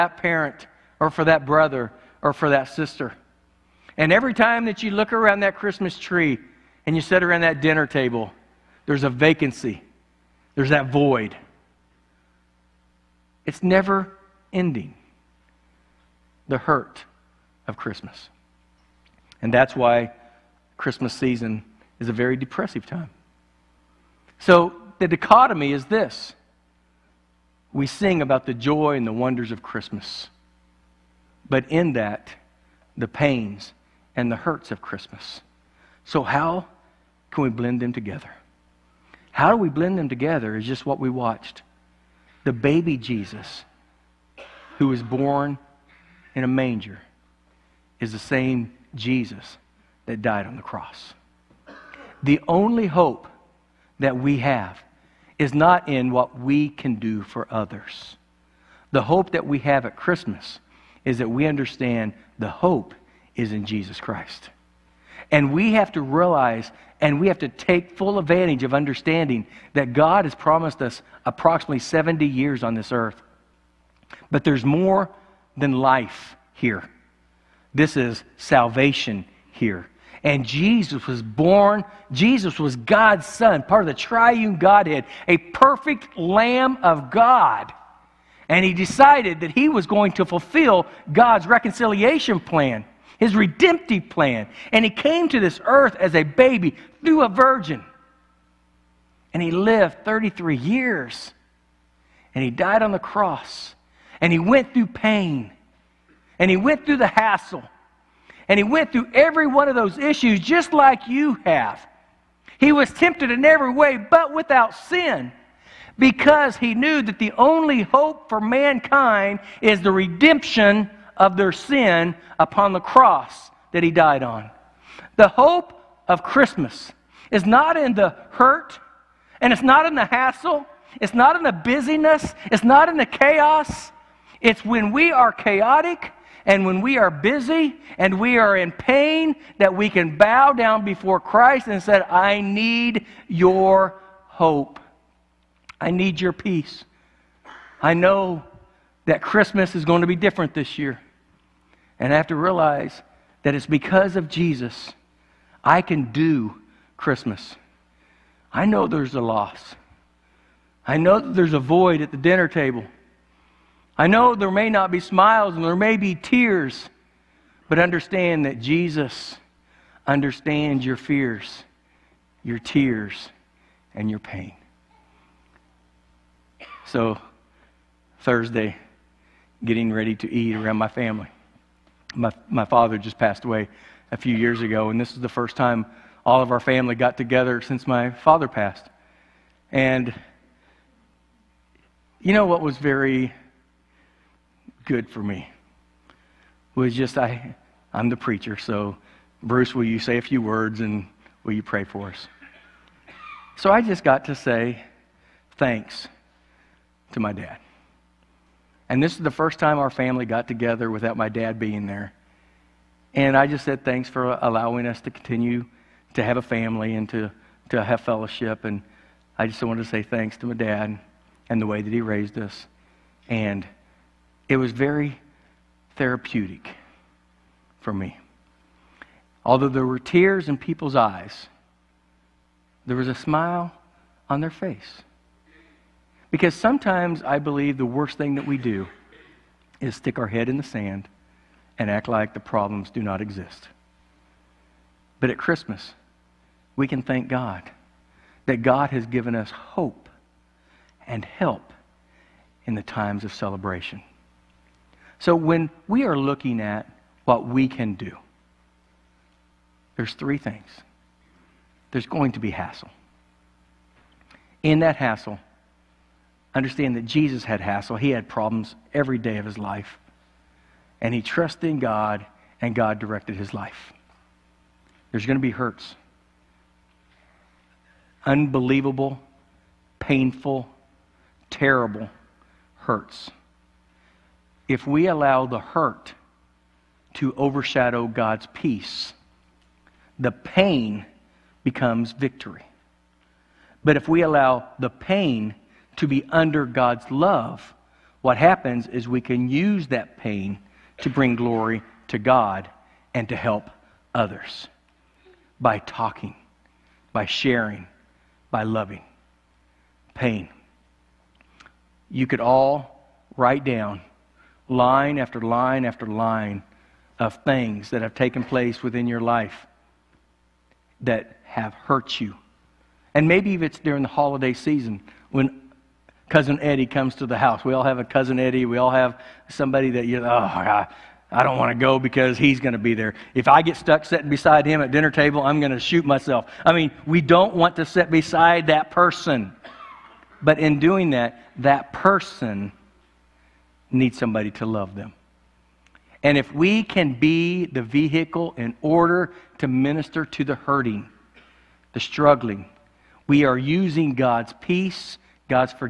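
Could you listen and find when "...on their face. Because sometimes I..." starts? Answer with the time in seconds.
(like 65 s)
234 s.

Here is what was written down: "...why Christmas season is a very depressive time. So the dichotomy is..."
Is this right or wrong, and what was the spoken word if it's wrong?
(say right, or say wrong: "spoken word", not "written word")
right.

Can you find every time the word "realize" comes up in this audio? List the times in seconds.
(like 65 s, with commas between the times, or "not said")
66 s, 152 s.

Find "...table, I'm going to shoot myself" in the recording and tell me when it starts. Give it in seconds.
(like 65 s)
335 s.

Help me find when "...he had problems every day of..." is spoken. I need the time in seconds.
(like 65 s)
267 s.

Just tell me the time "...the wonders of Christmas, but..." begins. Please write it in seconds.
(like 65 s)
29 s.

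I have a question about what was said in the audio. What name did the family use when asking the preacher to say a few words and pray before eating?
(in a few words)
Bruce.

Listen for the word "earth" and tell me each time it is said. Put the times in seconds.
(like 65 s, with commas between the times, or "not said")
72 s, 95 s.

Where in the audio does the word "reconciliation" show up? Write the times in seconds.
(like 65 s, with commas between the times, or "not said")
91 s.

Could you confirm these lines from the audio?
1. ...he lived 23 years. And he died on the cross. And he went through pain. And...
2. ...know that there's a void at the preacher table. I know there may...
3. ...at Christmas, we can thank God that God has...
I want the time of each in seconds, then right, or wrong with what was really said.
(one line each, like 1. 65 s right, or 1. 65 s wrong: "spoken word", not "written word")
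1. 99 s wrong: "33", not "23"
2. 160 s wrong: "dinner", not "preacher"
3. 245 s right.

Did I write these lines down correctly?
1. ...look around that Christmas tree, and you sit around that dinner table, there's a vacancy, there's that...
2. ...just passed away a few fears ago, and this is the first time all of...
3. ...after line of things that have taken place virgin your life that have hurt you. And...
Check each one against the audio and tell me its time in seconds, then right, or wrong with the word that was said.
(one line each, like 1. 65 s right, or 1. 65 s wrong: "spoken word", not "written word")
1. 4 s right
2. 182 s wrong: "years", not "fears"
3. 315 s wrong: "within", not "virgin".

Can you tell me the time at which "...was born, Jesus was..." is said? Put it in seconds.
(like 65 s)
81 s.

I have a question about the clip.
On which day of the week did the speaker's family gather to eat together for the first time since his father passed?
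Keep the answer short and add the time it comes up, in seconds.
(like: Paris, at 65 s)
Thursday, at 178 s.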